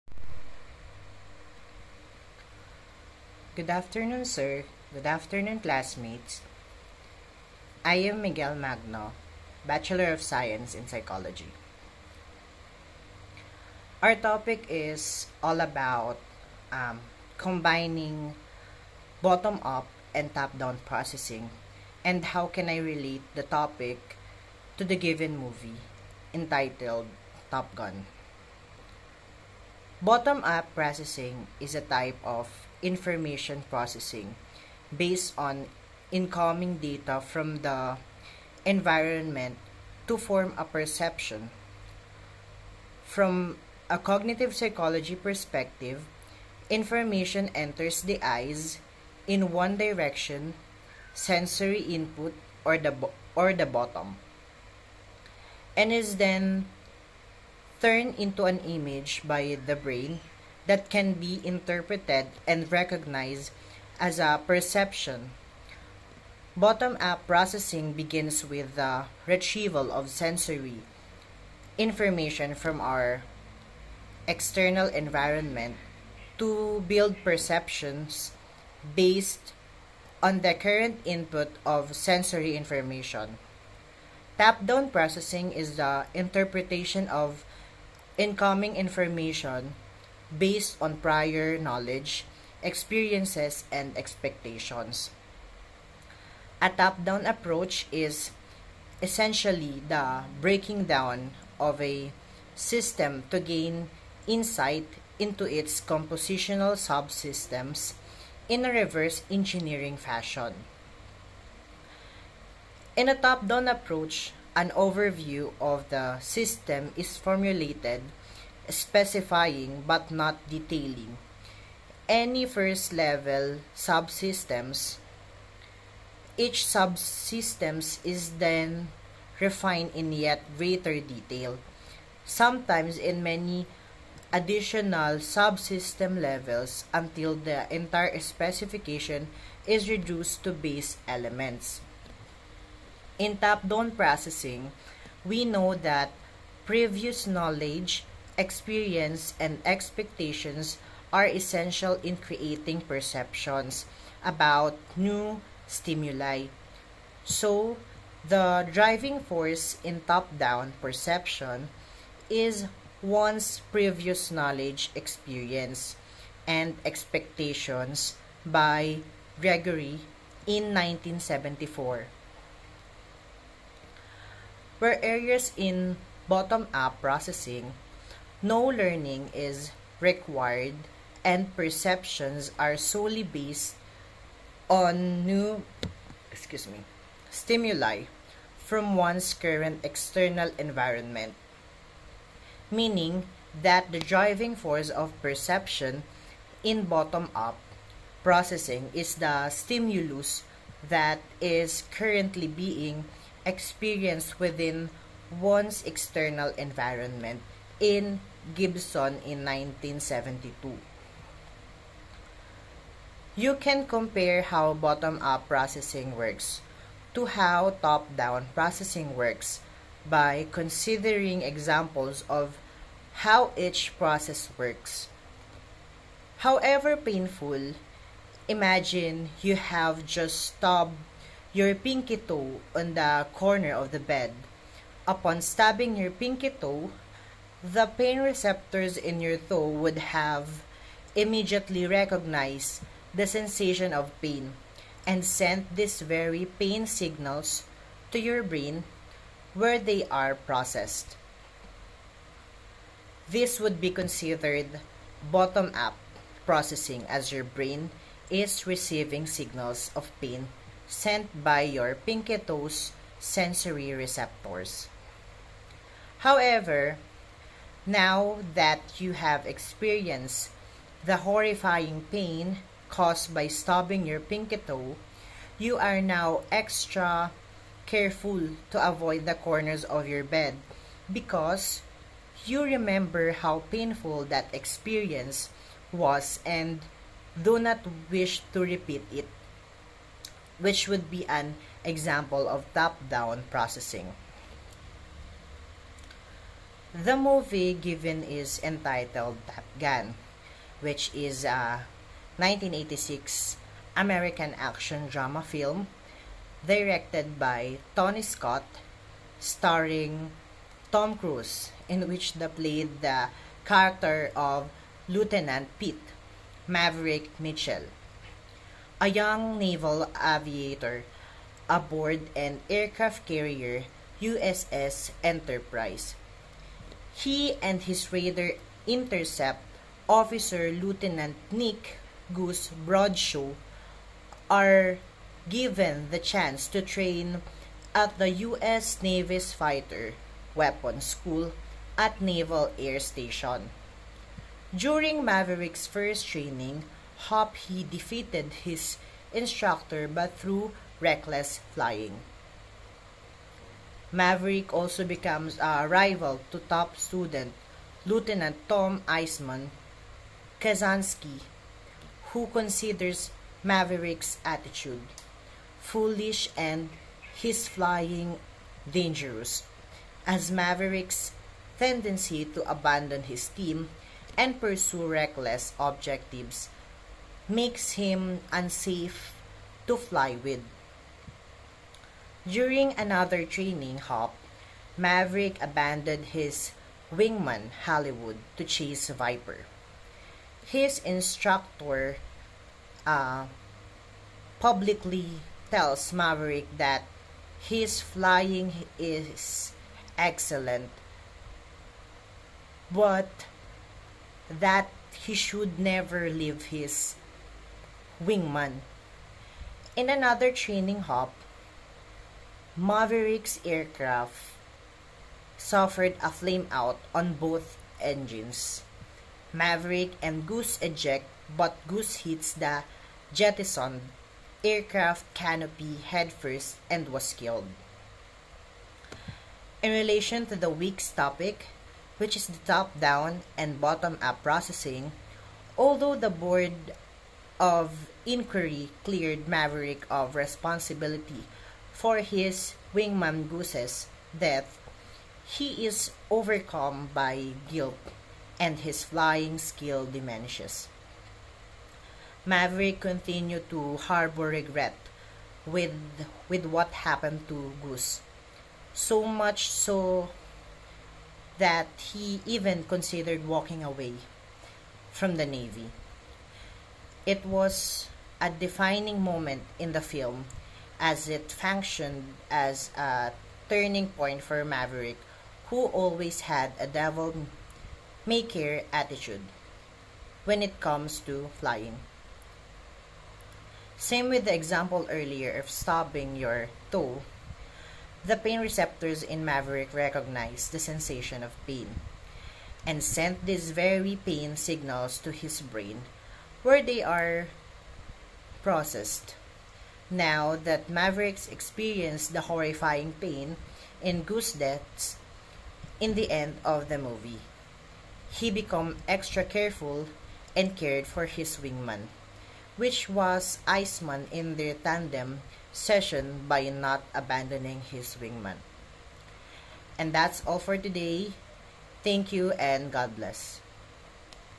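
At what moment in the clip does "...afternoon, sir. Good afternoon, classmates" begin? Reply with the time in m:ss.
0:03.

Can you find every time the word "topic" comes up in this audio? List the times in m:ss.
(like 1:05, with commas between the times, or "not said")
0:14, 0:23, 7:11.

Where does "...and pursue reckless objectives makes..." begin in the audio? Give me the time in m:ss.
6:14.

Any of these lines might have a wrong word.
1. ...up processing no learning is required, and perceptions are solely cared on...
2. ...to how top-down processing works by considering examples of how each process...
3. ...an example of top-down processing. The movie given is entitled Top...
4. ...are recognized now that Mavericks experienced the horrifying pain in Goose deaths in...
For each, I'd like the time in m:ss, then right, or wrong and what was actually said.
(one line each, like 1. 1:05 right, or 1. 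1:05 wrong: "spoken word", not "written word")
1. 2:56 wrong: "based", not "cared"
2. 3:37 right
3. 4:51 right
4. 8:17 wrong: "processed", not "recognized".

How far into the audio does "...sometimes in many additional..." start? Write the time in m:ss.
2:12.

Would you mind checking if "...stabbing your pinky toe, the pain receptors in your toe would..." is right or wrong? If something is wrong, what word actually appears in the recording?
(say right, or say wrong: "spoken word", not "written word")
right.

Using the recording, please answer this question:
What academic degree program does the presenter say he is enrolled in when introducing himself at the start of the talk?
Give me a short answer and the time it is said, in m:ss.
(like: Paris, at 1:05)
Bachelor of Science in Psychology, at 0:09.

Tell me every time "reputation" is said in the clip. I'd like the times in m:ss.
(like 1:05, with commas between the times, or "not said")
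not said.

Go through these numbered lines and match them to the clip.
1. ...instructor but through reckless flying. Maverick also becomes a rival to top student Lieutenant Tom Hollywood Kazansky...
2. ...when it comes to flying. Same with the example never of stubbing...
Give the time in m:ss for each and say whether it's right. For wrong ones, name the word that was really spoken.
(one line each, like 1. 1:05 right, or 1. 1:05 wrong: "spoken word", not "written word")
1. 5:49 wrong: "Iceman", not "Hollywood"
2. 8:00 wrong: "earlier", not "never".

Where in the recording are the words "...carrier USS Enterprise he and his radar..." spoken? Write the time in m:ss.
5:23.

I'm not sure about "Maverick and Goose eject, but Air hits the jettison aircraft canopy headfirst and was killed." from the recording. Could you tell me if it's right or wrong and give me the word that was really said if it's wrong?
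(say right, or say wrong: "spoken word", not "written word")
wrong: "Goose", not "Air".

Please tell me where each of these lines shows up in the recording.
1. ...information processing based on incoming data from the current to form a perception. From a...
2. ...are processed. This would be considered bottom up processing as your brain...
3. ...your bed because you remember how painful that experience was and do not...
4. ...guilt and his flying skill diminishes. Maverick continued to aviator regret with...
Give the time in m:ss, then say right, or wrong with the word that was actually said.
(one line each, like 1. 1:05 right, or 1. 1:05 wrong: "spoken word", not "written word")
1. 0:32 wrong: "environment", not "current"
2. 4:10 right
3. 4:40 right
4. 7:27 wrong: "harbor", not "aviator".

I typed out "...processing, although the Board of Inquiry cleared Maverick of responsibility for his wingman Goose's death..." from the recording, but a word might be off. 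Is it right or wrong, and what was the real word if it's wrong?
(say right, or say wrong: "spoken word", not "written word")
right.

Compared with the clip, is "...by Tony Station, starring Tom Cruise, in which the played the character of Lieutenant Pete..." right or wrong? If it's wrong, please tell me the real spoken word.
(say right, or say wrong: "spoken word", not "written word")
wrong: "Scott", not "Station".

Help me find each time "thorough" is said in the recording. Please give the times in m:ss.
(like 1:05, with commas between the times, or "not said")
not said.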